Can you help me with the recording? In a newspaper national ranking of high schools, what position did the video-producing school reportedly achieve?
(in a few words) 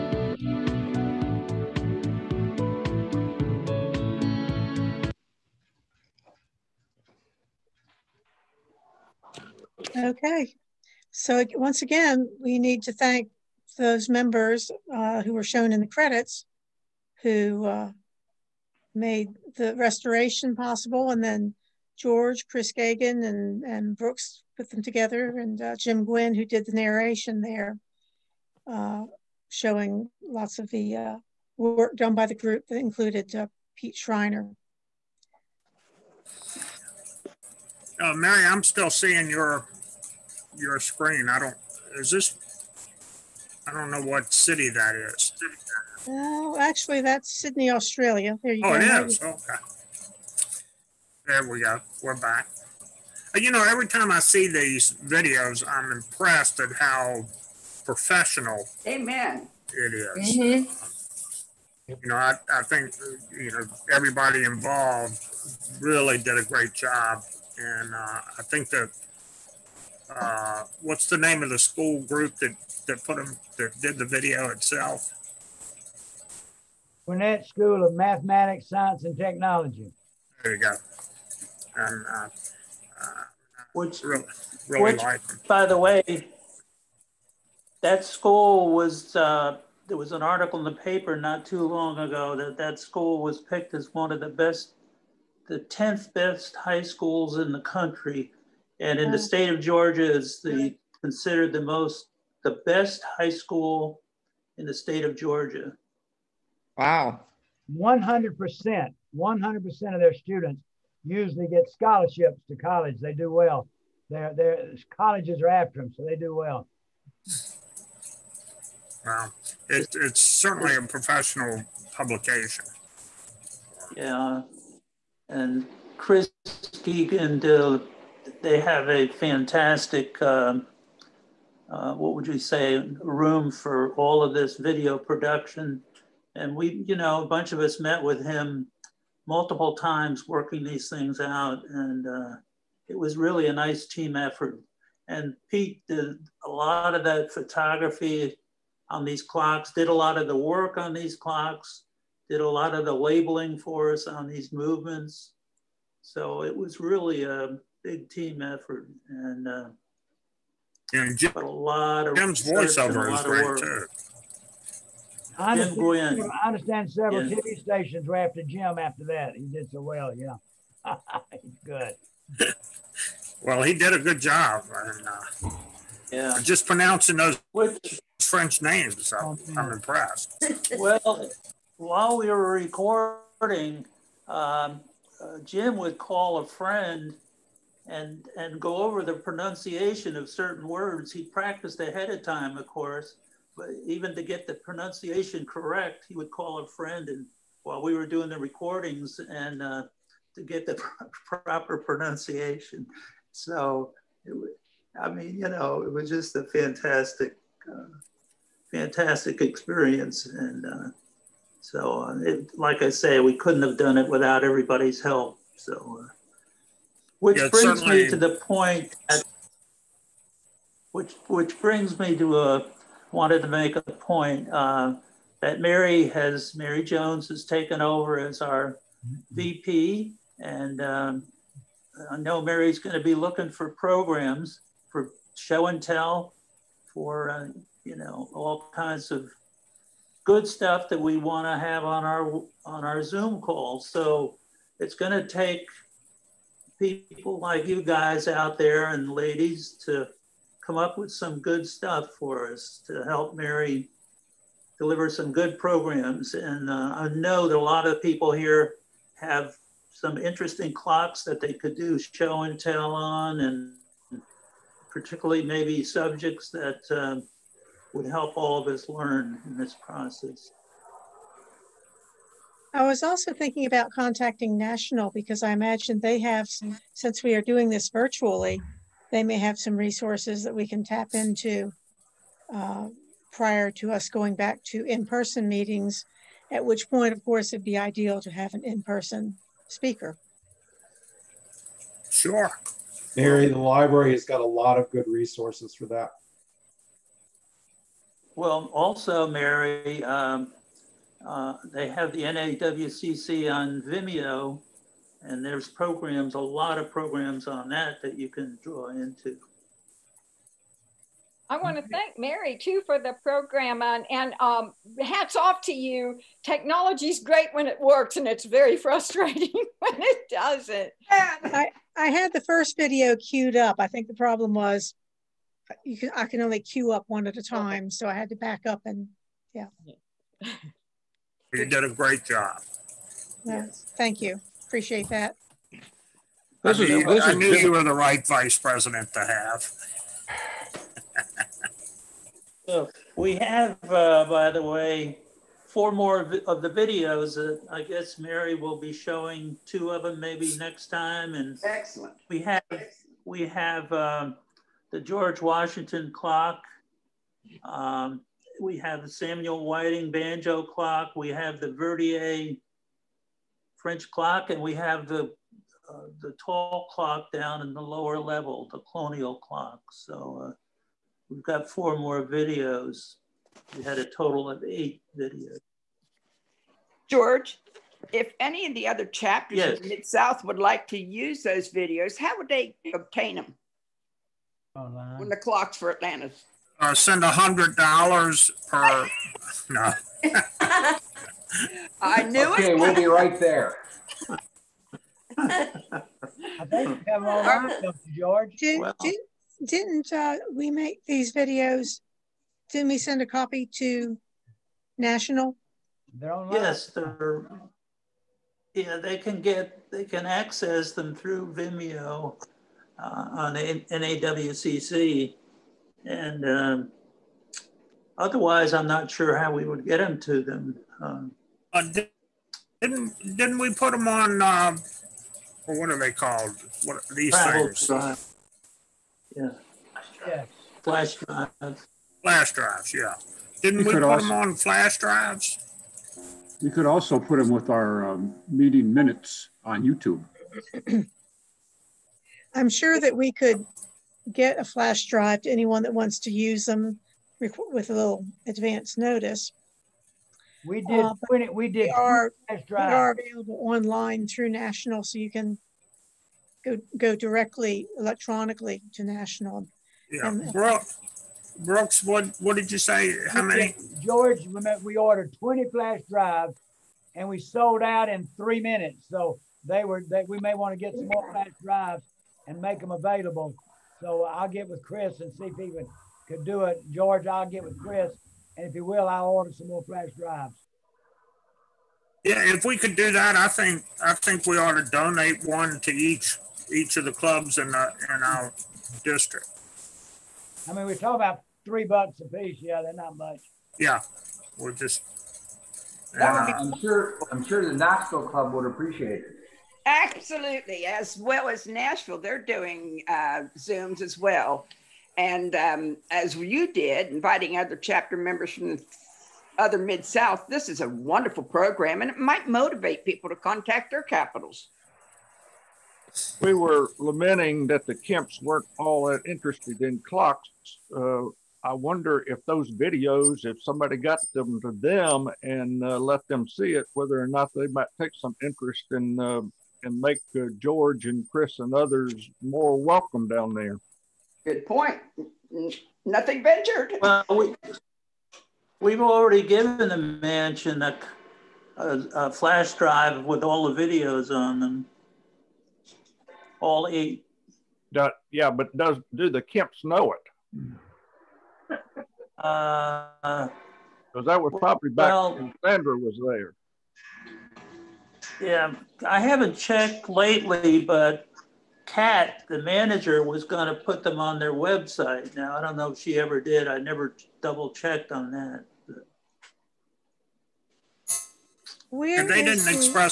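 10th.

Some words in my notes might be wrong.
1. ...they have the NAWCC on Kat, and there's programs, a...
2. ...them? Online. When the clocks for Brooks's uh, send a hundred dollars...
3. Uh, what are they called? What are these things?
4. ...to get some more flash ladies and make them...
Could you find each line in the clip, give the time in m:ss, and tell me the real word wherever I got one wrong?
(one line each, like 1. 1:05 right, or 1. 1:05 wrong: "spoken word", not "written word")
1. 5:01 wrong: "Vimeo", not "Kat"
2. 6:23 wrong: "Atlanta", not "Brooks"
3. 7:04 right
4. 7:50 wrong: "drives", not "ladies".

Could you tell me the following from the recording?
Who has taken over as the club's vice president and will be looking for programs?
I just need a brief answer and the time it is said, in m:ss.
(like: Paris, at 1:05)
Mary Jones, at 3:46.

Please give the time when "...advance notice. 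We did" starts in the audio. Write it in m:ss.
7:28.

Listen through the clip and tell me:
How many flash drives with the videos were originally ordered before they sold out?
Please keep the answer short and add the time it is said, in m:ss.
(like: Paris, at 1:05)
20, at 7:45.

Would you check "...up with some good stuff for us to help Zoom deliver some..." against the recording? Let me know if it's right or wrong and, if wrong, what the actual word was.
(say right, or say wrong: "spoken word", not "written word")
wrong: "Mary", not "Zoom".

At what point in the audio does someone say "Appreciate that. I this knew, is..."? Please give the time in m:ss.
5:34.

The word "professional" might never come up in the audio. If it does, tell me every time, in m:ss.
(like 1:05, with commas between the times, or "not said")
0:57, 2:00.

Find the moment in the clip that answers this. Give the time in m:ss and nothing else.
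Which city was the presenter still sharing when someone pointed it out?
0:47.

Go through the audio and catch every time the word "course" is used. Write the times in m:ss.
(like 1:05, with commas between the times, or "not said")
3:12, 4:47.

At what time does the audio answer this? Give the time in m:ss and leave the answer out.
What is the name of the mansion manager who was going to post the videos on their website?
9:21.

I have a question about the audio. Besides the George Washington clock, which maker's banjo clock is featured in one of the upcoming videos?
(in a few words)
Samuel Whiting.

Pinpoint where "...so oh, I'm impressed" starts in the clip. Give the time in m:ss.
2:59.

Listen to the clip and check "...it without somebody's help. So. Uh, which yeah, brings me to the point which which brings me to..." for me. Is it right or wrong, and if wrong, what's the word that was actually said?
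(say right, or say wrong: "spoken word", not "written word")
wrong: "everybody", not "somebody".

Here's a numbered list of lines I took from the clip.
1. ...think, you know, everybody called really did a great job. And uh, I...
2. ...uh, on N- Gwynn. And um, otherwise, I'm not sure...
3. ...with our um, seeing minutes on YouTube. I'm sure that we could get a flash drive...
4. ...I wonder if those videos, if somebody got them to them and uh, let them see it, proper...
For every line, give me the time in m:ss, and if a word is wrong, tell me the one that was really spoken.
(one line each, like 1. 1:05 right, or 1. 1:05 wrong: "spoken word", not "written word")
1. 1:02 wrong: "involved", not "called"
2. 6:52 wrong: "NAWCC", not "Gwynn"
3. 7:17 wrong: "meeting", not "seeing"
4. 8:41 wrong: "whether", not "proper".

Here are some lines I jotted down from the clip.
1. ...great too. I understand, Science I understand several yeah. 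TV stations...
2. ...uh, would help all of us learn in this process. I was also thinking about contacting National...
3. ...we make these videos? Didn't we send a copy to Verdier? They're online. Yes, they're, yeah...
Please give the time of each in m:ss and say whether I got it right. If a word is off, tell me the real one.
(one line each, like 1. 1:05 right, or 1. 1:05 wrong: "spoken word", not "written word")
1. 2:43 wrong: "Jim", not "Science"
2. 4:26 right
3. 6:40 wrong: "National", not "Verdier".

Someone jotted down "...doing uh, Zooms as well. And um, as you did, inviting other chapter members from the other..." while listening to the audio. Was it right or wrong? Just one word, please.
right.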